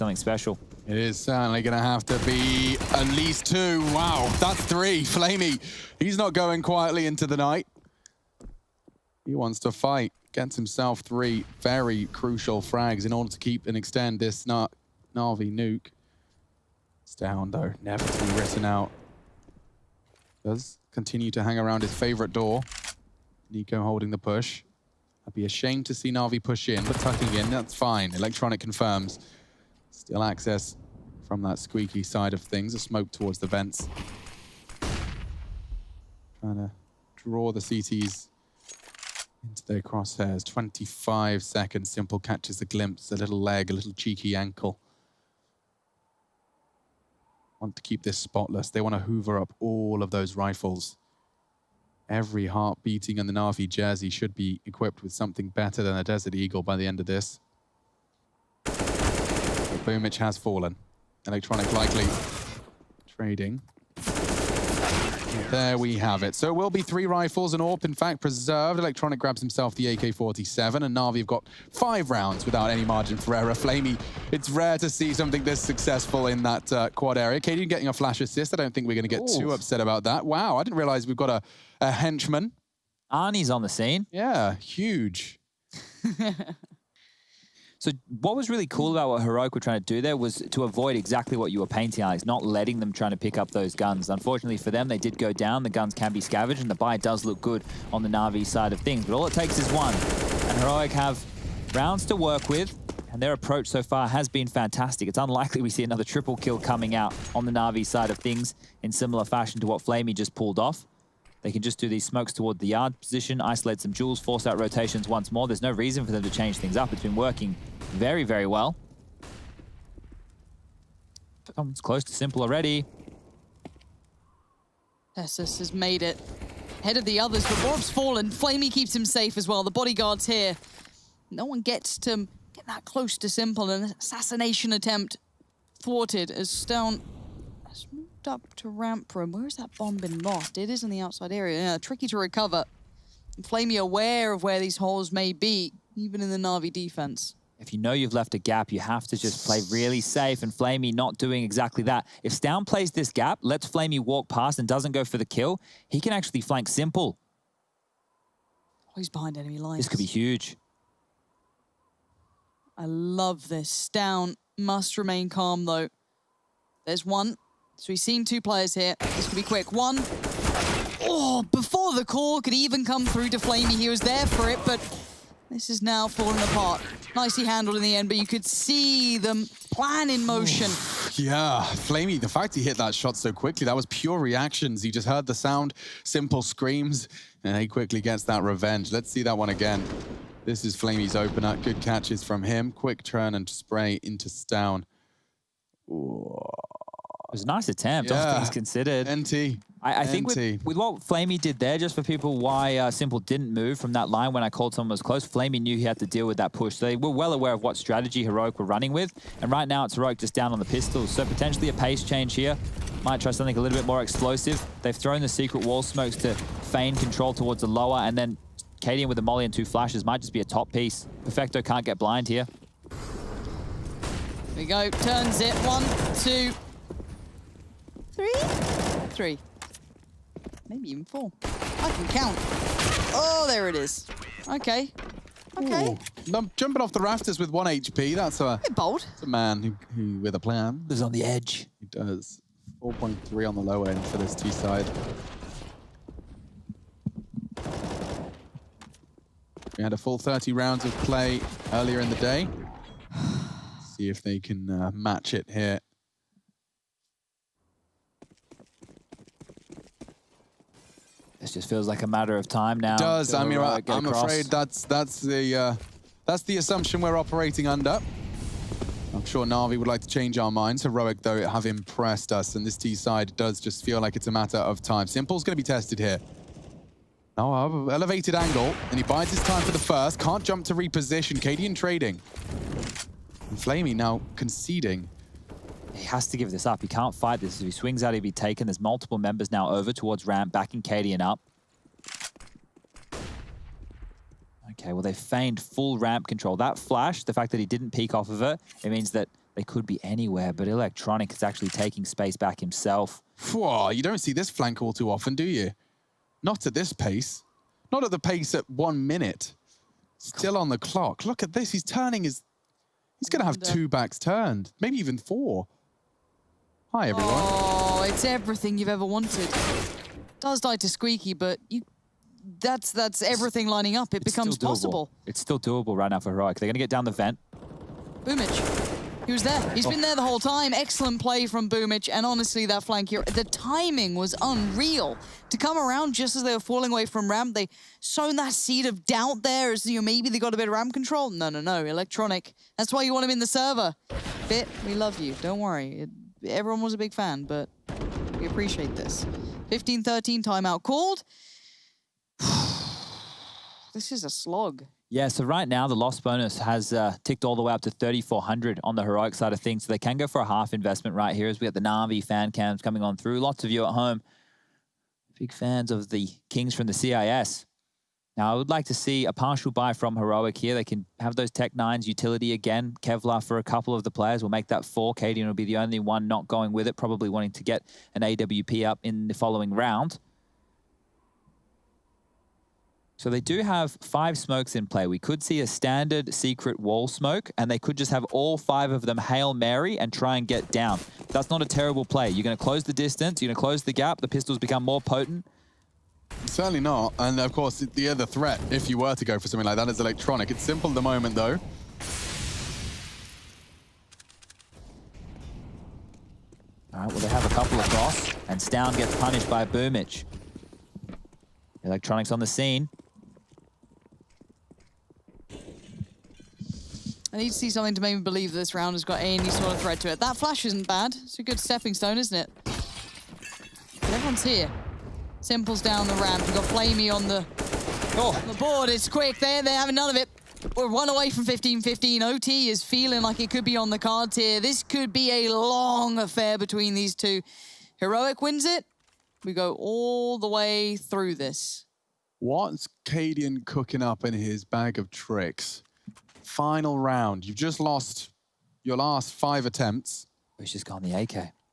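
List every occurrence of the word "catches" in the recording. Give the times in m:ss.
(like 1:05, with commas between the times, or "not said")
0:42, 3:11.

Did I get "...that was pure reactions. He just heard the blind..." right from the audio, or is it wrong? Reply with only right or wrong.
wrong.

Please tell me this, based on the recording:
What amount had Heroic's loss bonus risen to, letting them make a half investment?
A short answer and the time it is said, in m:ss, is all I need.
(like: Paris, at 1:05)
3,400, at 5:57.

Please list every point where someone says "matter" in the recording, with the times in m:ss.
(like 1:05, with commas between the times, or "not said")
4:22, 4:34.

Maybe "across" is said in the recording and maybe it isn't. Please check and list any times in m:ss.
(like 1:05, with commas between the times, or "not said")
4:24, 6:47.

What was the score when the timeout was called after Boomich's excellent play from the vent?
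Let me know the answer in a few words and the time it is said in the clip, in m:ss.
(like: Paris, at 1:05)
15-13, at 5:49.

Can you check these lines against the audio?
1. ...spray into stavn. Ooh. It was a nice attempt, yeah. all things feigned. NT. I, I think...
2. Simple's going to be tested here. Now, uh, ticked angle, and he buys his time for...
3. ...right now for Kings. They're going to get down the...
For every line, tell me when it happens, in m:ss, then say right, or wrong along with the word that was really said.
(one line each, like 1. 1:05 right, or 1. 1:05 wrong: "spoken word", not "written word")
1. 3:13 wrong: "considered", not "feigned"
2. 4:35 wrong: "elevated", not "ticked"
3. 5:25 wrong: "Heroic", not "Kings".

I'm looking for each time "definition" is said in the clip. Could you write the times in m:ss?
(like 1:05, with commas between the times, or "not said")
not said.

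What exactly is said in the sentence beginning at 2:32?
If stavn plays this gap, lets Flamey walk past and doesn't go for the kill, he can actually flank simple.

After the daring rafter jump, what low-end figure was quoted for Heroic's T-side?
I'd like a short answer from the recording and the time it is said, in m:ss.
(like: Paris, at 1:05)
4.3, at 4:02.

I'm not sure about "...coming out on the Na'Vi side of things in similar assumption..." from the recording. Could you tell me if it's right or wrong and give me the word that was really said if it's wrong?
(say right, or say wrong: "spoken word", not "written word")
wrong: "fashion", not "assumption".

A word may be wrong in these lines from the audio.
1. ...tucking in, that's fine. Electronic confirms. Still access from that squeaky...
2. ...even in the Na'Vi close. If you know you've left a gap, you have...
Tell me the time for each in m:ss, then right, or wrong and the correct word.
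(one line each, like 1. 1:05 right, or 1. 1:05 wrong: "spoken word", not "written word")
1. 0:26 right
2. 2:25 wrong: "defense", not "close".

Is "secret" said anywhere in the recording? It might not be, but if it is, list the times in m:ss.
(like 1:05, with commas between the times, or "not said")
3:35, 6:26.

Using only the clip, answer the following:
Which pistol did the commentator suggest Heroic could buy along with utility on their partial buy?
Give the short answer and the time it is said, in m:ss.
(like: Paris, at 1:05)
Tec-9, at 6:11.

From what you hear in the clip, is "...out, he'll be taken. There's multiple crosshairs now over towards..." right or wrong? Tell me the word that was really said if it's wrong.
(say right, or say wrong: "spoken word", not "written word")
wrong: "members", not "crosshairs".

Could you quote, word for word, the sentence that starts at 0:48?
They want to hoover up all of those rifles.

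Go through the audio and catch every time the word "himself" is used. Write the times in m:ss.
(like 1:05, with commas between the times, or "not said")
0:10, 1:09, 5:02.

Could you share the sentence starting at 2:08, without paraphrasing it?
Flamey keeps him safe as well.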